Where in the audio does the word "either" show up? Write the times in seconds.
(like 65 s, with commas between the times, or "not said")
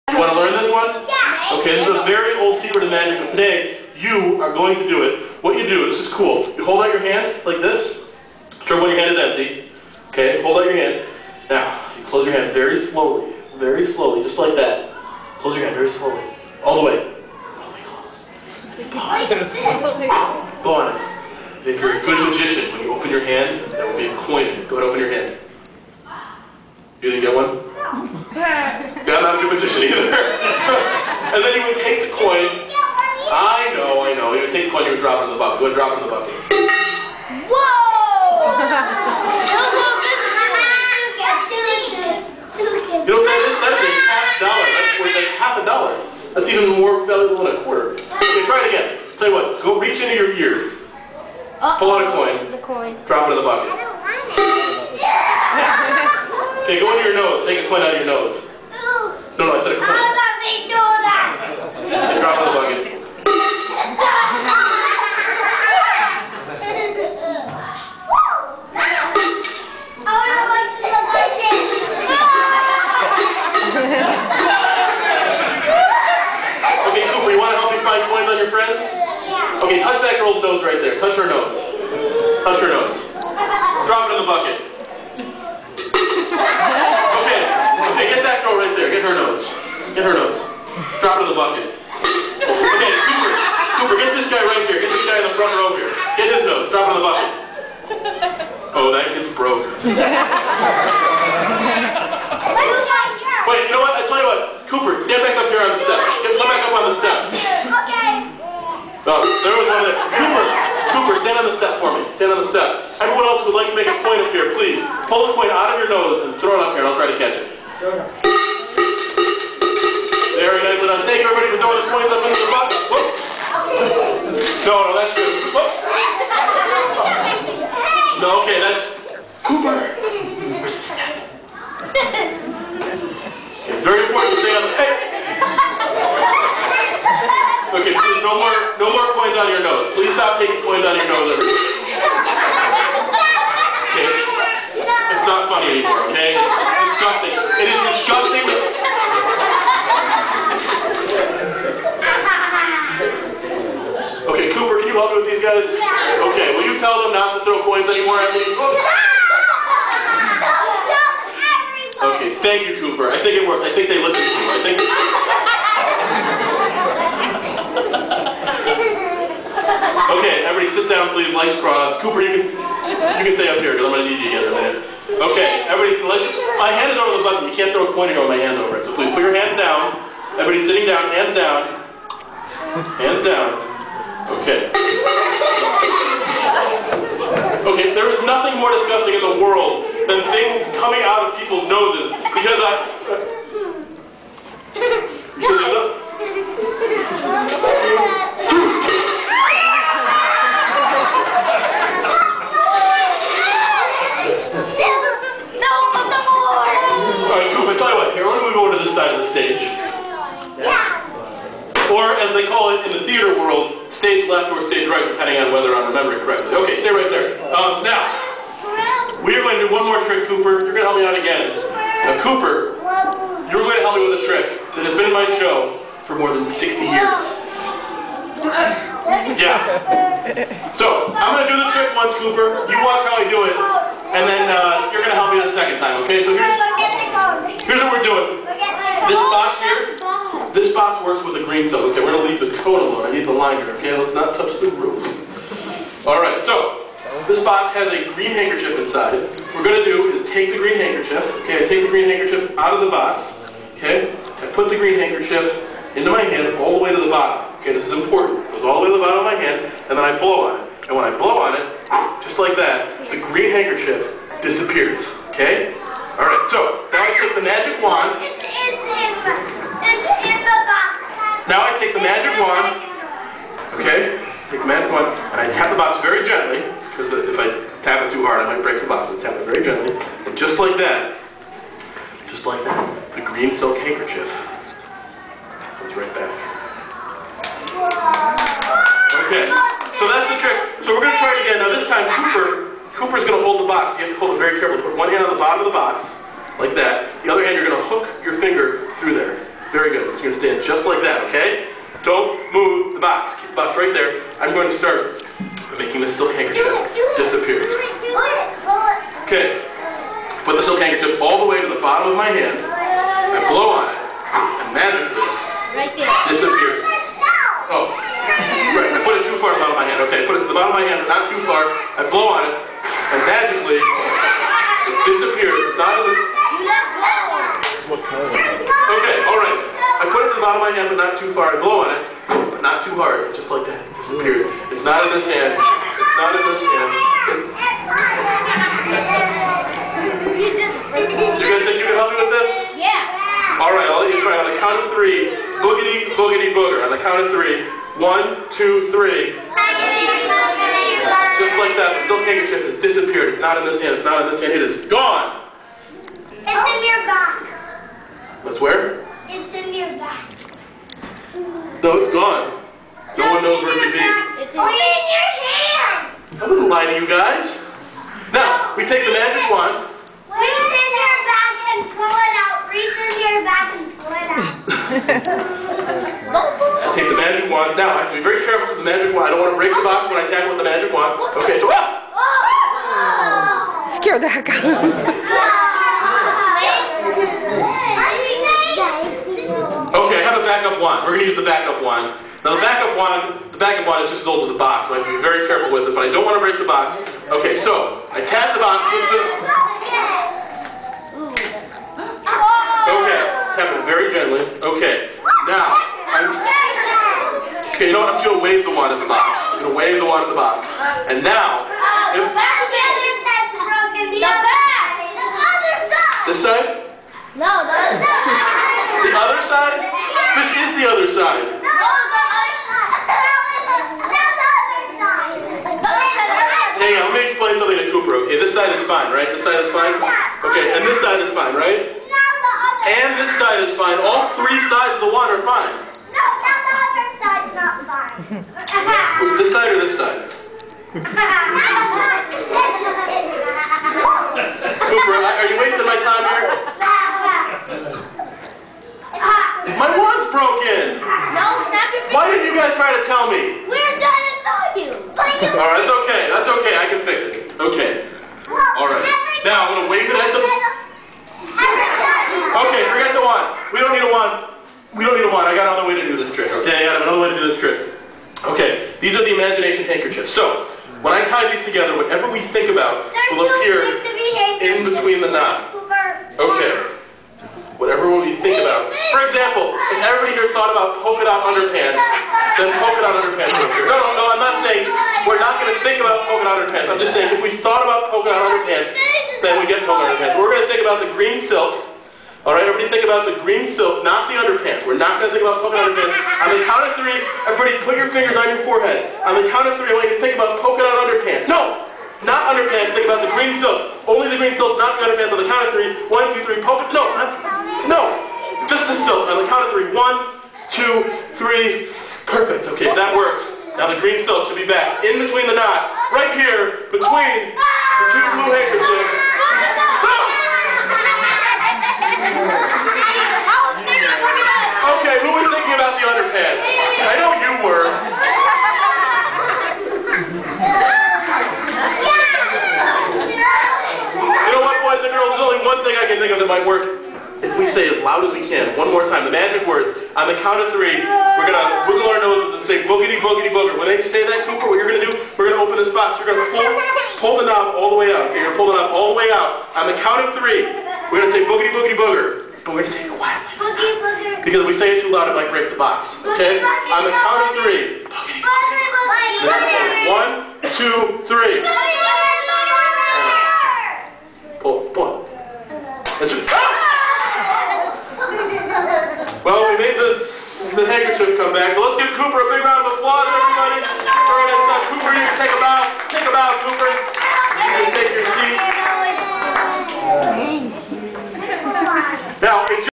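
29 s.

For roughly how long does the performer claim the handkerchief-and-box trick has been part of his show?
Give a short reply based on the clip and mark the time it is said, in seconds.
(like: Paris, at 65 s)
more than 60 years, at 226 s.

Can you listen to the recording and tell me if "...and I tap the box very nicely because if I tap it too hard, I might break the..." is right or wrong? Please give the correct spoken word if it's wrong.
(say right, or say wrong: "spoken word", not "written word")
wrong: "gently", not "nicely".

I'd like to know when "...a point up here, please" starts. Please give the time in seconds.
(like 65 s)
113 s.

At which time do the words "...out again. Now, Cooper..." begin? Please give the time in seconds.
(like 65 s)
221 s.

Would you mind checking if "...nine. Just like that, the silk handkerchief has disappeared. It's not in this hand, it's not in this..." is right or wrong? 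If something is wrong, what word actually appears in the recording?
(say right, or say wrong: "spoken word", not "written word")
wrong: "three", not "nine".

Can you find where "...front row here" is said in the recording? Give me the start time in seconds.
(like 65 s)
95 s.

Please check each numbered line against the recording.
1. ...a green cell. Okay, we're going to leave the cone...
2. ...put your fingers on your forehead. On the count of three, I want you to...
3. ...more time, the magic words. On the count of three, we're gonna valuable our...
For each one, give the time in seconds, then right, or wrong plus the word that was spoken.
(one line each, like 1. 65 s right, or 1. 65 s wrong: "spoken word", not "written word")
1. 241 s right
2. 497 s right
3. 538 s wrong: "wiggle", not "valuable".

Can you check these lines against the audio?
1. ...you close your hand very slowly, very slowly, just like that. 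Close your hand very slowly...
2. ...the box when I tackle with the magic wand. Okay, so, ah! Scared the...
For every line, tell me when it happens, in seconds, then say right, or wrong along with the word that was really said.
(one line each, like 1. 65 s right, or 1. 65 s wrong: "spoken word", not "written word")
1. 11 s right
2. 379 s right.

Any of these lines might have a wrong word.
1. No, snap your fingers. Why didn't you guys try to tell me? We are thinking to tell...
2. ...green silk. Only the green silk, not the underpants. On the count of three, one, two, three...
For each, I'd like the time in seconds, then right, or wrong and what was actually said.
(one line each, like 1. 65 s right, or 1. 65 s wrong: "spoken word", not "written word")
1. 451 s wrong: "trying", not "thinking"
2. 503 s right.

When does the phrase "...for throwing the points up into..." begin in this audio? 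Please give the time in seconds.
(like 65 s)
121 s.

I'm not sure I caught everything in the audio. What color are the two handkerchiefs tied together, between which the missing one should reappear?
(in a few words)
blue.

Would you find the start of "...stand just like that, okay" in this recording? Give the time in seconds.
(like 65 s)
300 s.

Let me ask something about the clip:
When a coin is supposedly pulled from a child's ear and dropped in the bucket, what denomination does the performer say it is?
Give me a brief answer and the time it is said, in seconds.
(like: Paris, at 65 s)
half dollar, at 44 s.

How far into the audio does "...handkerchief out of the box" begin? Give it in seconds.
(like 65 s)
252 s.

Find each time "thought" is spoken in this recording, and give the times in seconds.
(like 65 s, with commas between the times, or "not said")
480 s, 487 s.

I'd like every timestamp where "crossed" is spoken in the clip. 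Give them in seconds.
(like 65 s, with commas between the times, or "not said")
171 s.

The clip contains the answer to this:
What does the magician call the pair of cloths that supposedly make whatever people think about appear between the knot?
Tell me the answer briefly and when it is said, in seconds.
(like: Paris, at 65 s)
imagination handkerchiefs, at 469 s.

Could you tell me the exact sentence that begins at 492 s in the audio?
All right, everybody think about the green silk, not the underpants.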